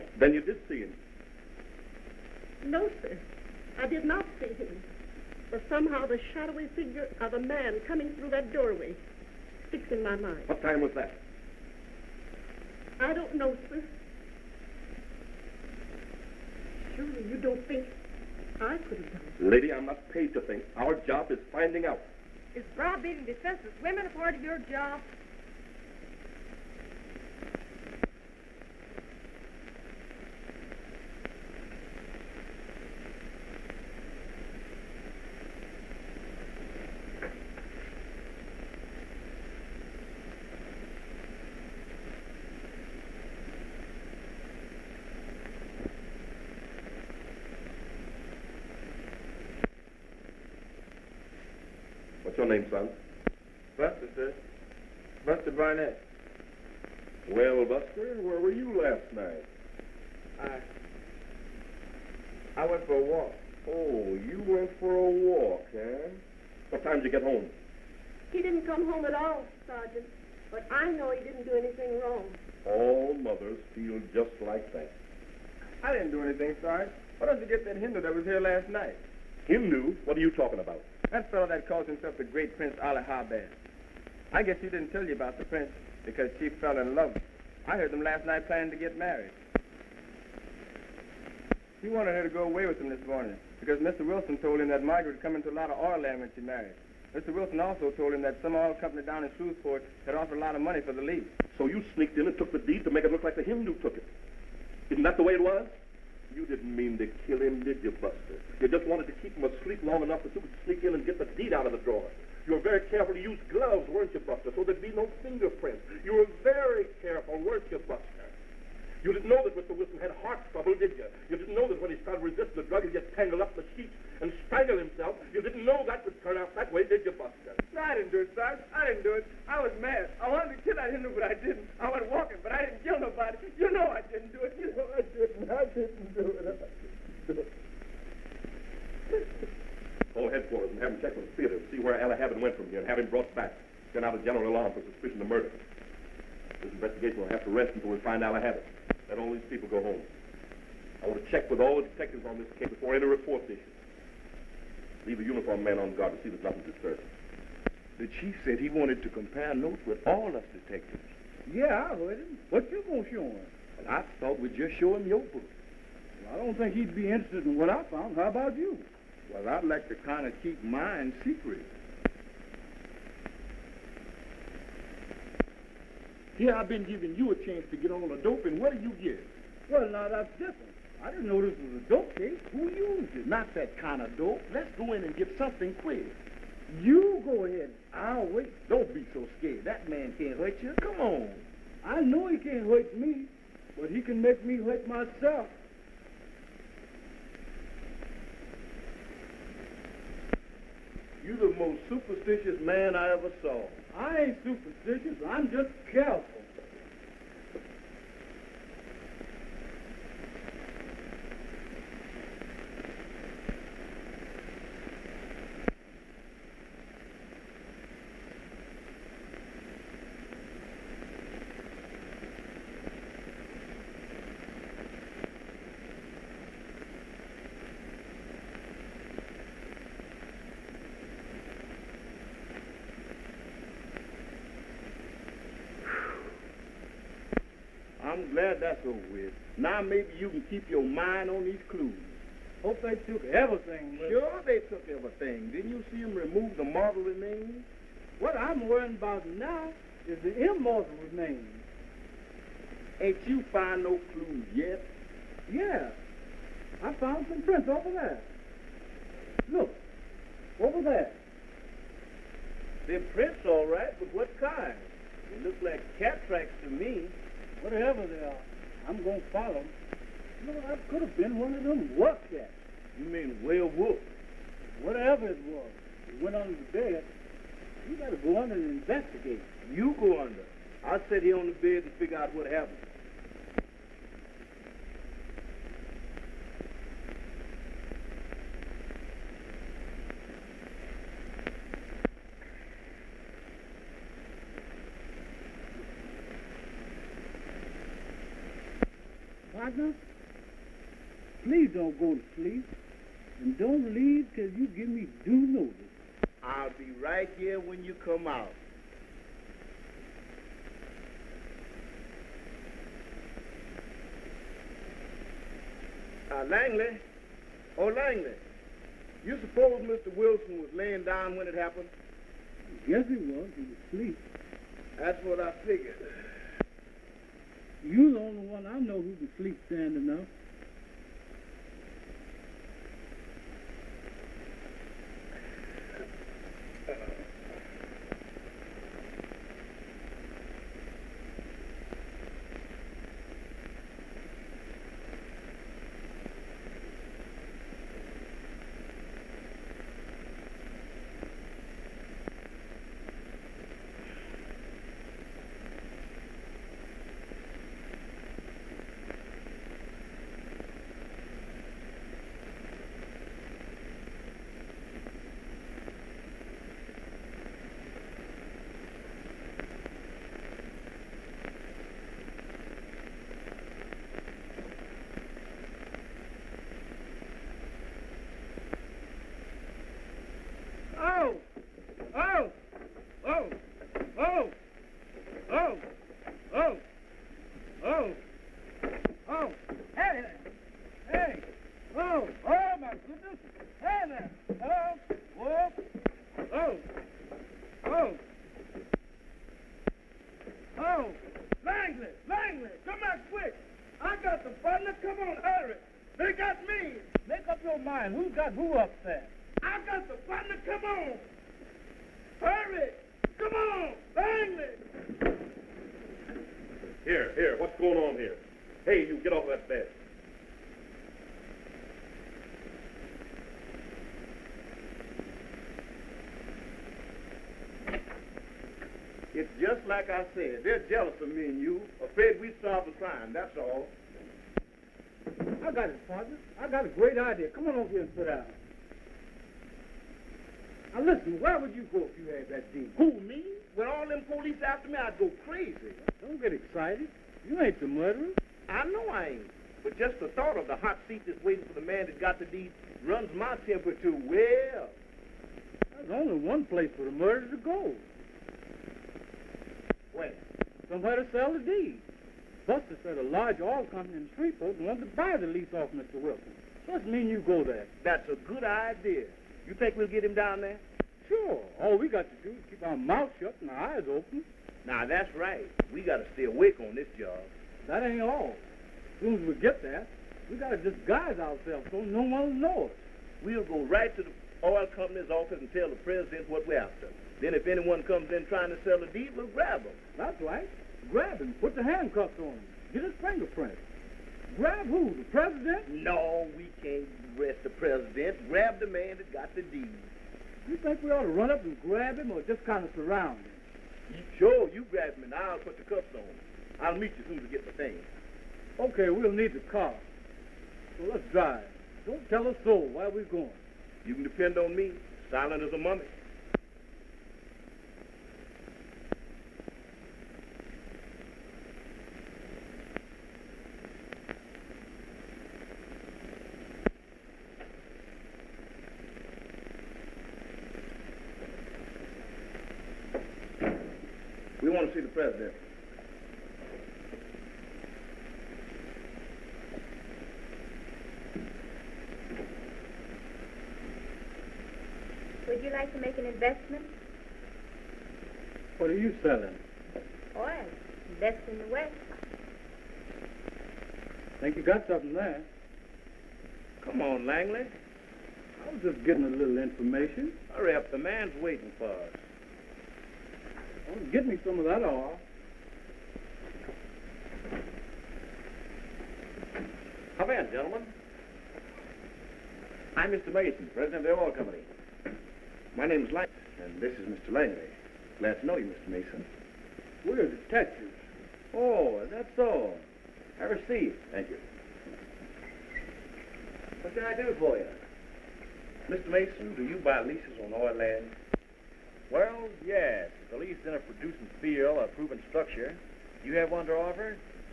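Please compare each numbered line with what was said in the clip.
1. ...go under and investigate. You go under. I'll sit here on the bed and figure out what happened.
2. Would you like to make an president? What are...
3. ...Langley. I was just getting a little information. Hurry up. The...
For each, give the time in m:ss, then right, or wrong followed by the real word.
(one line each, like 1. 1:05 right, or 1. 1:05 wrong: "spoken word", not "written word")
1. 4:38 right
2. 9:05 wrong: "investment", not "president"
3. 9:17 right.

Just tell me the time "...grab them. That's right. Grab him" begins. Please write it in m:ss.
8:09.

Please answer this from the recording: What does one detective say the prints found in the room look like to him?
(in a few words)
Cat tracks.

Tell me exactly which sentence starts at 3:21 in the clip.
You're the most superstitious man I ever saw.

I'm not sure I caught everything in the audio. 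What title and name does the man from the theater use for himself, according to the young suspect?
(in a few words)
Prince Ali.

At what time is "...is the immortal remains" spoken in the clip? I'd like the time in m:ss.
4:10.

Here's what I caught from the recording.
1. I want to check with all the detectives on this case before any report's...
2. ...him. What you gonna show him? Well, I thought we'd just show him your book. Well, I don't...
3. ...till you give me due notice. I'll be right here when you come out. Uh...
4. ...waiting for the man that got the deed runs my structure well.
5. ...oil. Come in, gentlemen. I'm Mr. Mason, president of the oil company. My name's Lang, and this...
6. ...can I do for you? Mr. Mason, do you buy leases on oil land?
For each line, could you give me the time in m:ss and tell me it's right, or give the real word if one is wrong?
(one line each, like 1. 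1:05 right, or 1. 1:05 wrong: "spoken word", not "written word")
1. 2:31 right
2. 2:42 right
3. 5:04 right
4. 7:31 wrong: "temperature", not "structure"
5. 9:24 right
6. 9:46 right.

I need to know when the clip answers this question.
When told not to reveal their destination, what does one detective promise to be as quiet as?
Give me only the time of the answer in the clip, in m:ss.
8:35.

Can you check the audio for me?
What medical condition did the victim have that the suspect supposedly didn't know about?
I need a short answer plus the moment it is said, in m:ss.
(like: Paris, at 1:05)
Heart trouble, at 2:00.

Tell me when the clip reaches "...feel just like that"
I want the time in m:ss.
1:13.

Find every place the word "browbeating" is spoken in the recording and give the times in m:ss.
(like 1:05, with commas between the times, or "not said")
0:22.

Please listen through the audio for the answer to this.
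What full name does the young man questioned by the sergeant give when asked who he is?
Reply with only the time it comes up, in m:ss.
0:55.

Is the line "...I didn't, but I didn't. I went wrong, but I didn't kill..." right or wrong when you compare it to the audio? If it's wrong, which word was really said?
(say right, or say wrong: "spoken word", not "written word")
wrong: "walking", not "wrong".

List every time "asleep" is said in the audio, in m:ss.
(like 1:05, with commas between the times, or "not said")
1:49, 5:23.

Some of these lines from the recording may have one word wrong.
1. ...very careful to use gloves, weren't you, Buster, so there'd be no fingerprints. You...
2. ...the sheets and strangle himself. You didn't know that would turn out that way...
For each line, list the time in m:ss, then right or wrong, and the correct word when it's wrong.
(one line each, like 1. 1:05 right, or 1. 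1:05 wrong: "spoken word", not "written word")
1. 1:52 right
2. 2:03 right.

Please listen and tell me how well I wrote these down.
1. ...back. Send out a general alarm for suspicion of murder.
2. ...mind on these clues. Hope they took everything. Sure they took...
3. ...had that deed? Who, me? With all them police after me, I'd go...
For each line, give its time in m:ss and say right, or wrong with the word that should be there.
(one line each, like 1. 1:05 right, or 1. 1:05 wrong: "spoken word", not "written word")
1. 2:23 right
2. 4:00 right
3. 7:22 right.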